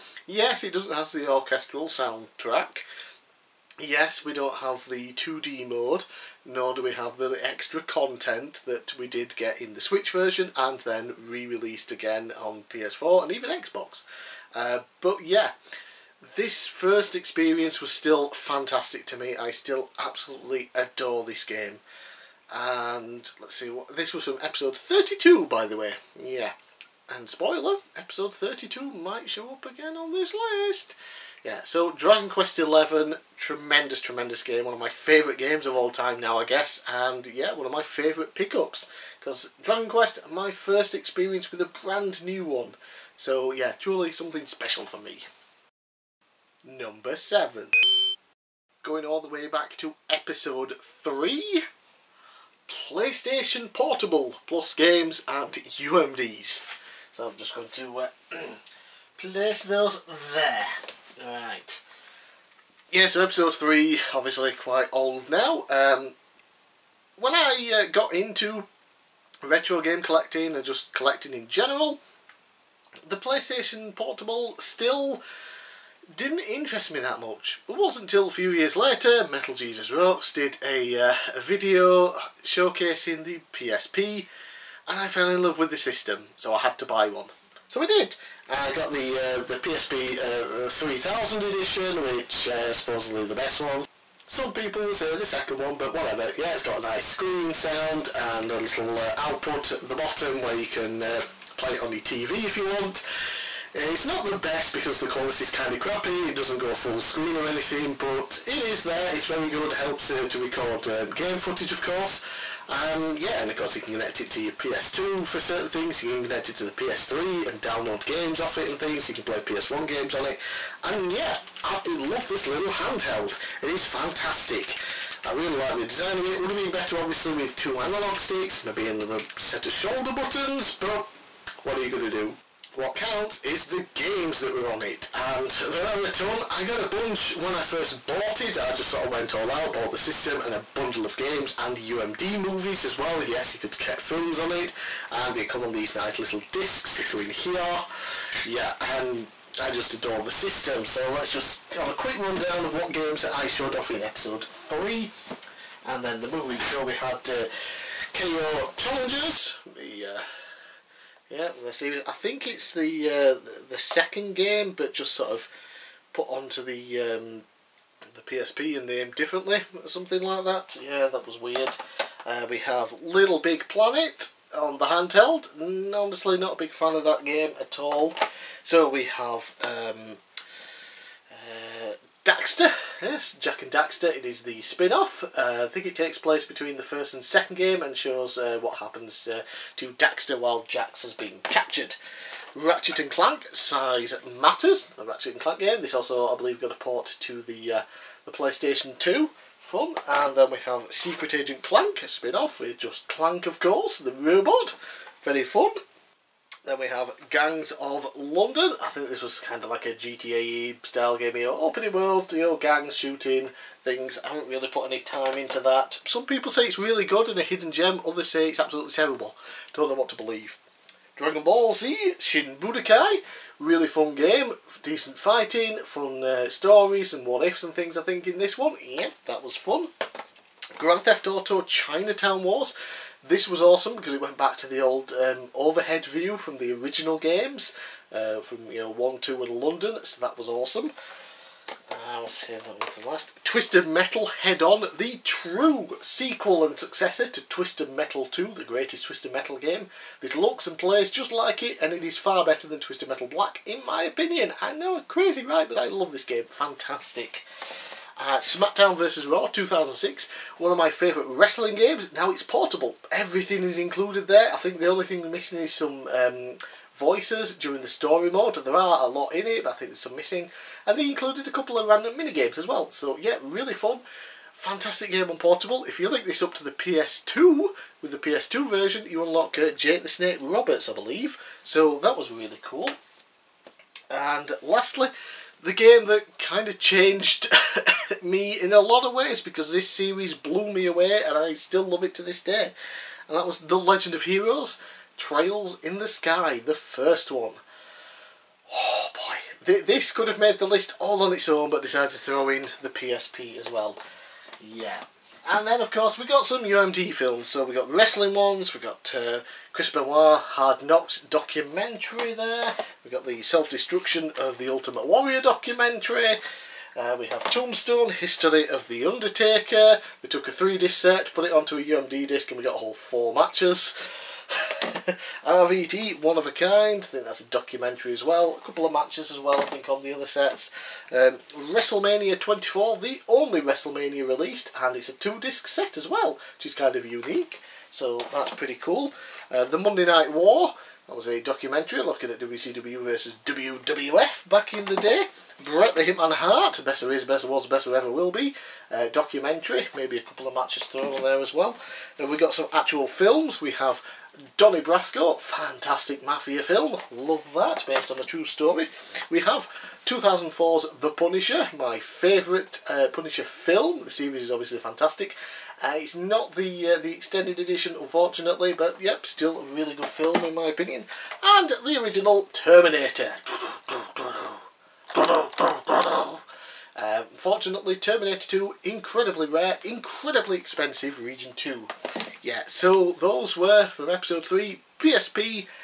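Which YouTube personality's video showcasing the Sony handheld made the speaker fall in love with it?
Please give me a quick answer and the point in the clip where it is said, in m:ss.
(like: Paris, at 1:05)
Metal Jesus Rocks, at 1:19.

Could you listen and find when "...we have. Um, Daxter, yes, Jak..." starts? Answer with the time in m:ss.
2:58.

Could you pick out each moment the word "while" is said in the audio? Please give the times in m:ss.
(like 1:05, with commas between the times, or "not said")
3:10.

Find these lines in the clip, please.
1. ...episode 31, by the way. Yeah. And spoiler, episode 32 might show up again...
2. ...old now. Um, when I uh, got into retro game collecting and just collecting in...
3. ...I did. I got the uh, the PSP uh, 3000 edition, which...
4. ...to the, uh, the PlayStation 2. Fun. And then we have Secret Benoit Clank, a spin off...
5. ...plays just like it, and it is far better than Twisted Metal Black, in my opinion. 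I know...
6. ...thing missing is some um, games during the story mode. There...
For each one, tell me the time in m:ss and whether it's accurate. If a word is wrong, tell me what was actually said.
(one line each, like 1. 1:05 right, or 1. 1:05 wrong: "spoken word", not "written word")
1. 0:24 wrong: "32", not "31"
2. 1:04 right
3. 1:27 right
4. 3:17 wrong: "Agent", not "Benoit"
5. 4:10 right
6. 4:25 wrong: "voices", not "games".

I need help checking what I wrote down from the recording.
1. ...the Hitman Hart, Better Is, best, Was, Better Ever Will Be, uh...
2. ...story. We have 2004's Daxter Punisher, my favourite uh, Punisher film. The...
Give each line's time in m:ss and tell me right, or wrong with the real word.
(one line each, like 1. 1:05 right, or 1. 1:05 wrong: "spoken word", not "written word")
1. 5:45 right
2. 5:58 wrong: "The", not "Daxter".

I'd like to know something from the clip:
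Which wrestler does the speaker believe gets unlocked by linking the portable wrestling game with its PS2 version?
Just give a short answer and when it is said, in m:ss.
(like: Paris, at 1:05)
Jake the Snake Roberts, at 4:39.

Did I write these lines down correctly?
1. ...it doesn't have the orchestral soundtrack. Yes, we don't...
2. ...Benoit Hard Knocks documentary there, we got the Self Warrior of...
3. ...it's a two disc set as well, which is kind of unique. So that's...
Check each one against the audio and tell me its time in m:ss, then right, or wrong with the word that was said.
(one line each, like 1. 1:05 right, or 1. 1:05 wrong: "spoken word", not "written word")
1. 0:00 right
2. 5:09 wrong: "Destruction", not "Warrior"
3. 5:34 right.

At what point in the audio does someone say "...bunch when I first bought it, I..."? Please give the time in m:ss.
2:16.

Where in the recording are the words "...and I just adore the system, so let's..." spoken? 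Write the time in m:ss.
2:28.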